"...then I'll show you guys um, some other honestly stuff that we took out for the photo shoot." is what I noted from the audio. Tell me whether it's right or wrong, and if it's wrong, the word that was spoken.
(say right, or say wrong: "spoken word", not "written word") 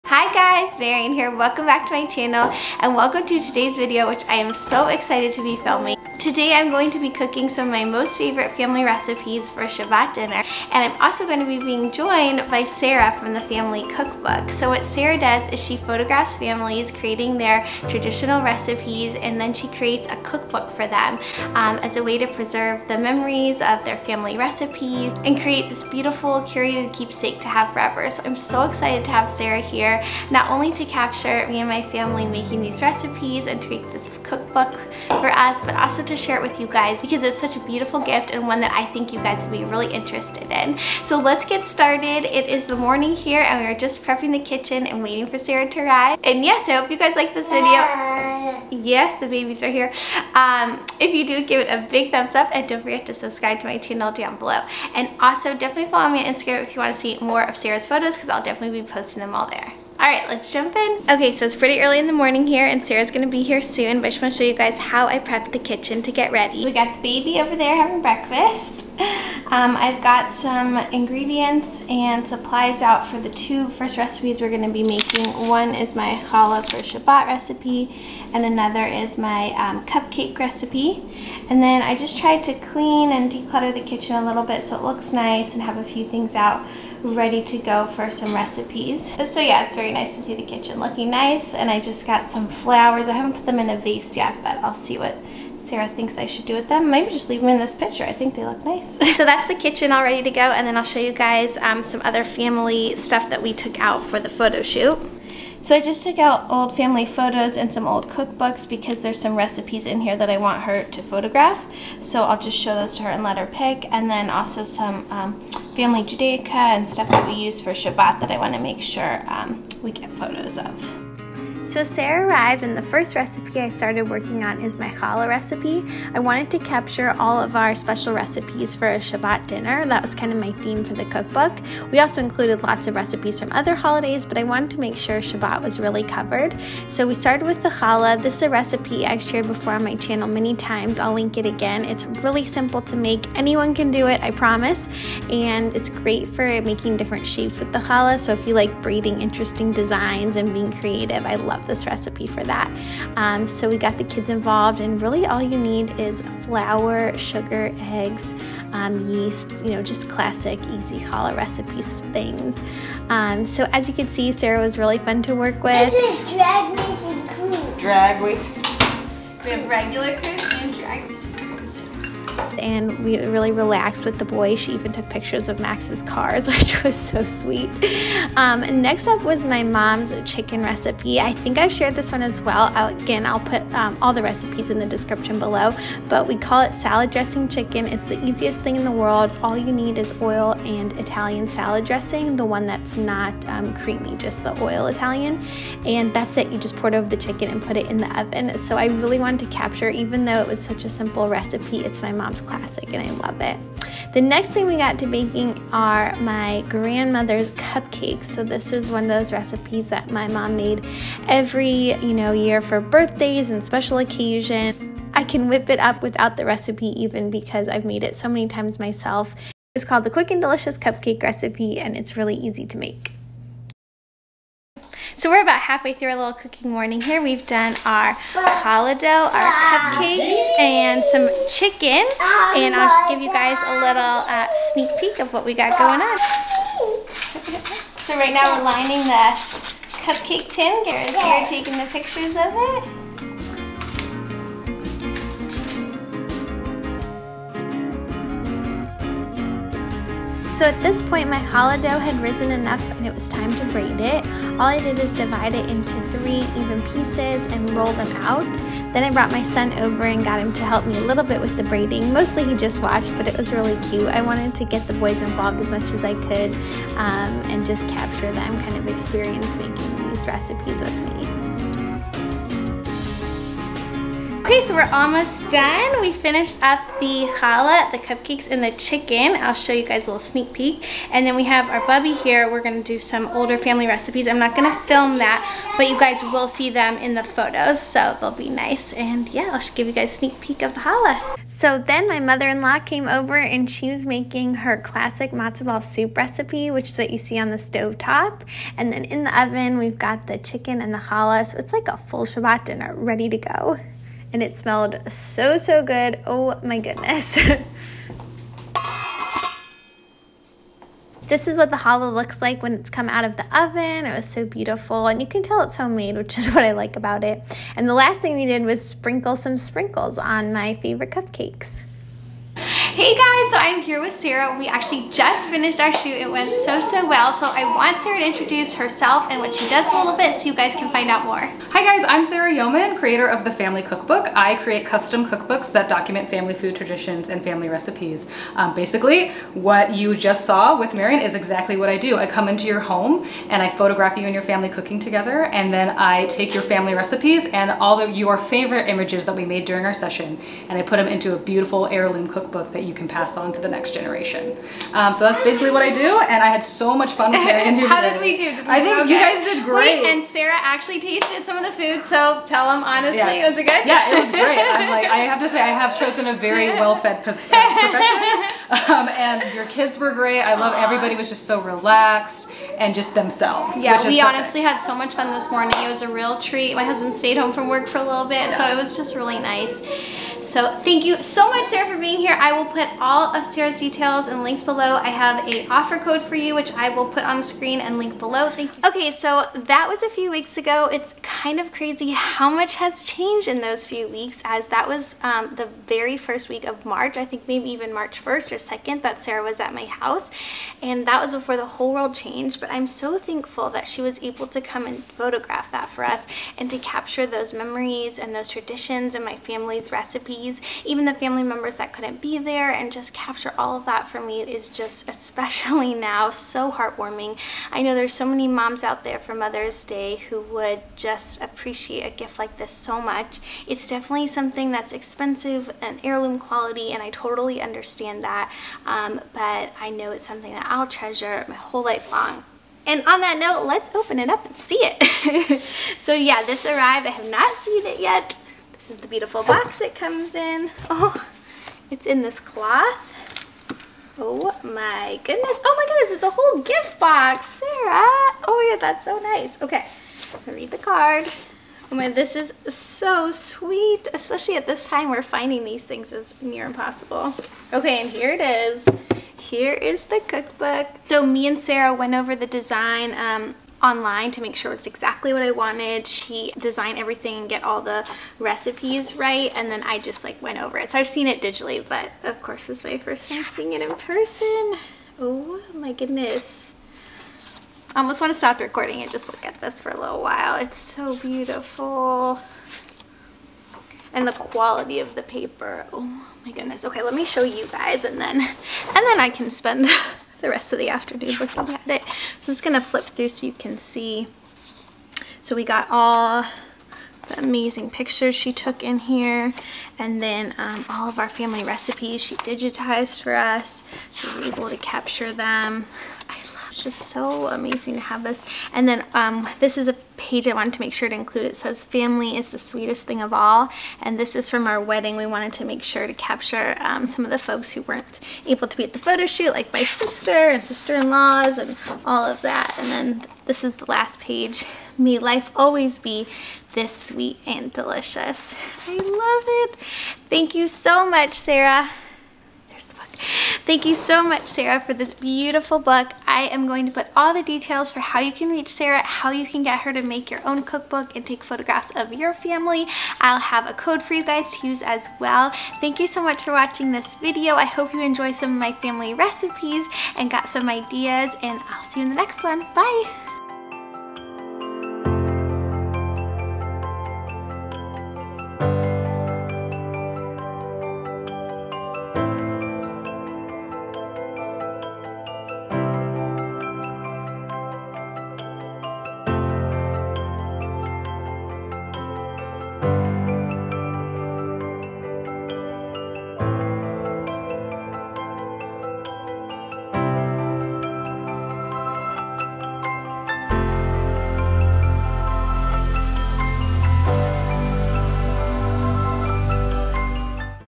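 wrong: "family", not "honestly".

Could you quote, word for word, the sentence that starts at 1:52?
So I'll just show those to her and let her pick.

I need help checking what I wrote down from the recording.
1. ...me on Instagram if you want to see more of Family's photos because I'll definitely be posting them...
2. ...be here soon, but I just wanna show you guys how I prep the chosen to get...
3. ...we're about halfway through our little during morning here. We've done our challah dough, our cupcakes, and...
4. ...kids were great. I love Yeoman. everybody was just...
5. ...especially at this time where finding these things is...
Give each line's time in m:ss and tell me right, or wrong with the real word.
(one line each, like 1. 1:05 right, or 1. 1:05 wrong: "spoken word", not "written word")
1. 0:56 wrong: "Sarah", not "Family"
2. 1:03 wrong: "kitchen", not "chosen"
3. 3:45 wrong: "cooking", not "during"
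4. 6:09 wrong: "Aww", not "Yeoman"
5. 7:34 right.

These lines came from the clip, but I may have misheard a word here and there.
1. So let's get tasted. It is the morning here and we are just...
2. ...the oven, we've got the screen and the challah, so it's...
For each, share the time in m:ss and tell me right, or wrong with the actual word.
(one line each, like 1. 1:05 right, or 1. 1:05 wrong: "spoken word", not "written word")
1. 0:41 wrong: "started", not "tasted"
2. 4:59 wrong: "chicken", not "screen".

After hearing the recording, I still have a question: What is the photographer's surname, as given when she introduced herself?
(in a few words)
Yeoman.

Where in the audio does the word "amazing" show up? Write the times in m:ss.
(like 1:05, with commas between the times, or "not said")
8:17, 8:27.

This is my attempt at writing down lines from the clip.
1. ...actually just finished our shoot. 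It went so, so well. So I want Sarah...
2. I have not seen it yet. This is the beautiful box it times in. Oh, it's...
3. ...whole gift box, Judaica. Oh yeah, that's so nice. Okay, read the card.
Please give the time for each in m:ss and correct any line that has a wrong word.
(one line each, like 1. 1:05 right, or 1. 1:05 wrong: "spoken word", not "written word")
1. 5:24 right
2. 7:17 wrong: "comes", not "times"
3. 7:26 wrong: "Sarah", not "Judaica".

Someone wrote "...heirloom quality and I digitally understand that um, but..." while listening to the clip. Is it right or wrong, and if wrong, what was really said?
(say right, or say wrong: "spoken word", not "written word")
wrong: "totally", not "digitally".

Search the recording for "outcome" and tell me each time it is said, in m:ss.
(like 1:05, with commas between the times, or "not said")
not said.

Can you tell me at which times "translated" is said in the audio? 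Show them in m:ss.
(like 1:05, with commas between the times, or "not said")
not said.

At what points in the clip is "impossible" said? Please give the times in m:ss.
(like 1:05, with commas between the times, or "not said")
7:36.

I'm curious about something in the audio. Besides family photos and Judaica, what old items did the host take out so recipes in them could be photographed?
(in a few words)
old cookbooks.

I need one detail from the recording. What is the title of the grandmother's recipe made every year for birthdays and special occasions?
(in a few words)
Quick and Delicious Cupcake Recipe.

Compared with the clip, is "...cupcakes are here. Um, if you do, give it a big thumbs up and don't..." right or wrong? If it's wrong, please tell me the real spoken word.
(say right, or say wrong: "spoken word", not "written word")
wrong: "babies", not "cupcakes".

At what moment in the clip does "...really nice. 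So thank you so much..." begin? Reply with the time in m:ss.
6:19.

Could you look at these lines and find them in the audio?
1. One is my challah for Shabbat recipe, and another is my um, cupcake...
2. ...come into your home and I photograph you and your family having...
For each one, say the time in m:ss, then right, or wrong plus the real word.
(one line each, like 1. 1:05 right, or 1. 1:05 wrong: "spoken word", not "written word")
1. 1:15 right
2. 5:42 wrong: "cooking", not "having".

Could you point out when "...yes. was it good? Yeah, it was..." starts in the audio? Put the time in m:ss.
6:03.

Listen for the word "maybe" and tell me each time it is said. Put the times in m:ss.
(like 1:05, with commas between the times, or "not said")
1:36, 6:37.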